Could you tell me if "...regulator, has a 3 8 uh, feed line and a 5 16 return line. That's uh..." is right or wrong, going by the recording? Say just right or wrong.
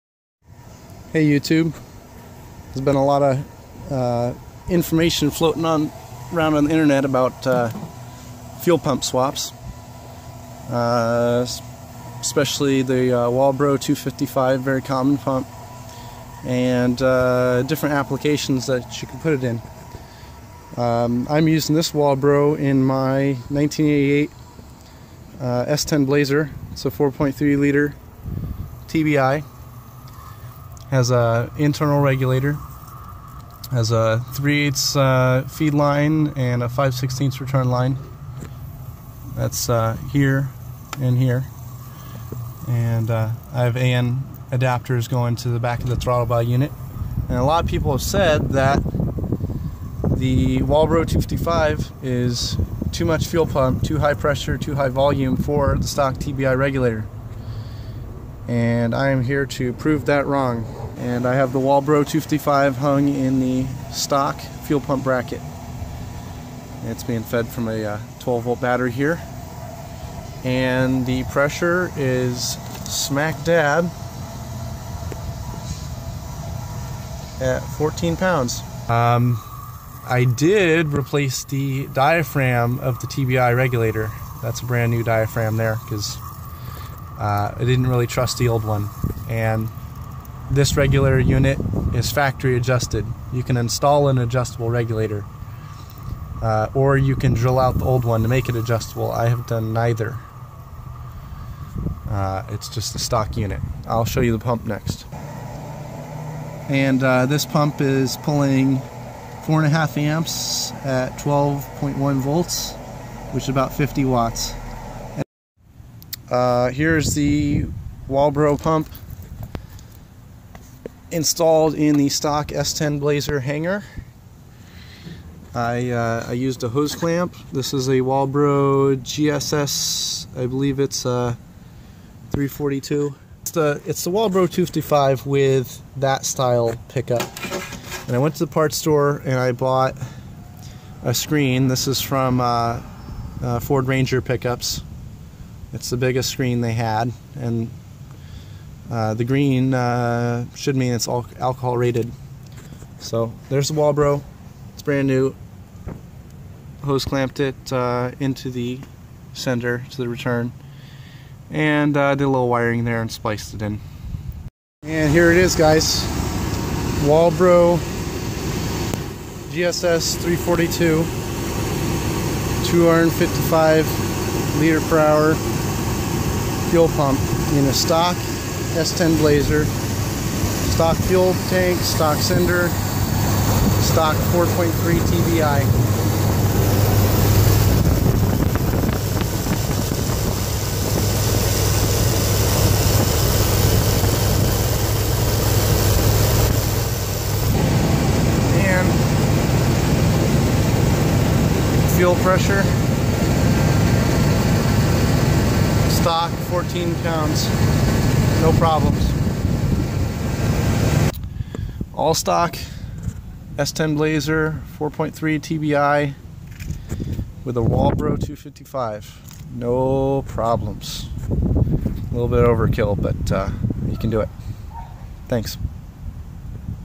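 right.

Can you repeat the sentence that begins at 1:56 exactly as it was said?
Uh, here's the Walbro pump installed in the stock S10 Blazer hanger.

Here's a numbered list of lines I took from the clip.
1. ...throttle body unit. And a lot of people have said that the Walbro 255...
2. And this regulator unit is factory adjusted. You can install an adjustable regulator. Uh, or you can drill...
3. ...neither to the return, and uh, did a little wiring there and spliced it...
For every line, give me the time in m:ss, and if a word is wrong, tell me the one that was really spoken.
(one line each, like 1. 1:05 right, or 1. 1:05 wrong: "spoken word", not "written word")
1. 0:45 right
2. 1:29 right
3. 2:39 wrong: "sender", not "neither".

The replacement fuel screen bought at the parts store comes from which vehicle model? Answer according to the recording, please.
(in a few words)
Ford Ranger.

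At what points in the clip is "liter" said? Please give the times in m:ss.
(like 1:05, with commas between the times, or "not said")
0:27, 2:54.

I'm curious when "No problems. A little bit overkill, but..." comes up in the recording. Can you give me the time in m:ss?
3:39.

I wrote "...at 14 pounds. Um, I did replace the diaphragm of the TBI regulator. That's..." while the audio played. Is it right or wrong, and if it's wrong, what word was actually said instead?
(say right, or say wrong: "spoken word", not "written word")
right.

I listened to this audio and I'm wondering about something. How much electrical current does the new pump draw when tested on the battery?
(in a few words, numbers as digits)
4.5 amps.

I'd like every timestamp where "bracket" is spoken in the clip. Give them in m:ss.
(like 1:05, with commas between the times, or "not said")
1:05.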